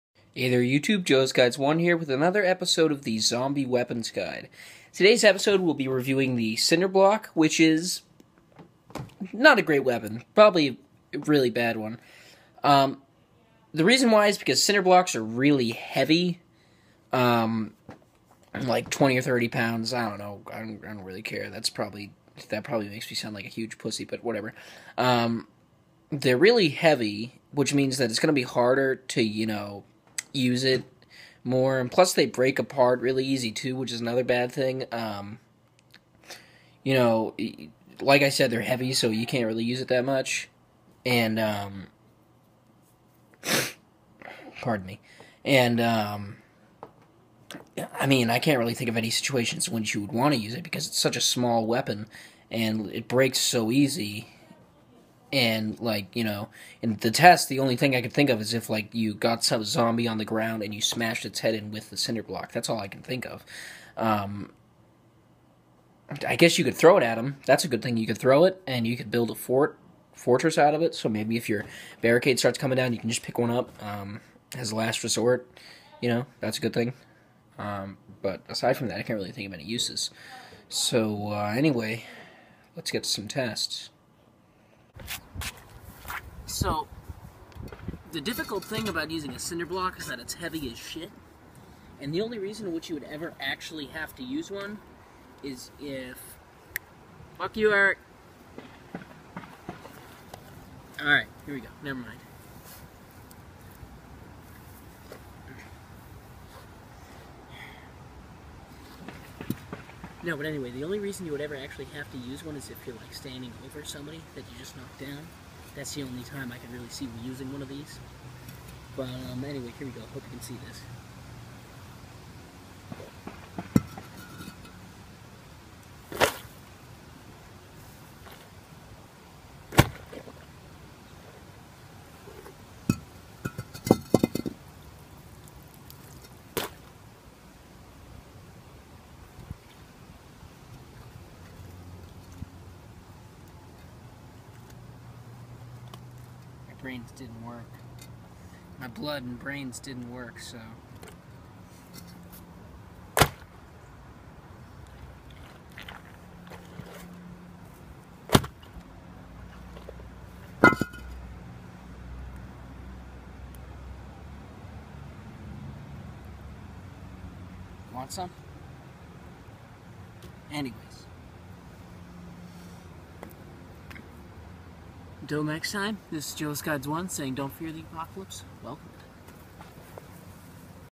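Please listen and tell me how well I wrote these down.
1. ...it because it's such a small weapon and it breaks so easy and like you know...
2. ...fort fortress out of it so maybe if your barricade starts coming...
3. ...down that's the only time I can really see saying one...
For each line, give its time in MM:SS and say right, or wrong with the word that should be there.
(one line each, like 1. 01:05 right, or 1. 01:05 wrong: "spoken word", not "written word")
1. 00:50 right
2. 01:09 right
3. 01:54 wrong: "using", not "saying".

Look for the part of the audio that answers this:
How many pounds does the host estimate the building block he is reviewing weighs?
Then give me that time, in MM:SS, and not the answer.
00:18.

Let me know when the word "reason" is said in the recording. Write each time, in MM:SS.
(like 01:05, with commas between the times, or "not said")
00:13, 01:32, 01:50.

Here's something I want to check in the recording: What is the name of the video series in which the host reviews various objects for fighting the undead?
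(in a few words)
Zombie Weapons Guide.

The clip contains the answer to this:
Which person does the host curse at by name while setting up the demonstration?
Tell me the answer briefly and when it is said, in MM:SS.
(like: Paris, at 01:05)
Eric, at 01:37.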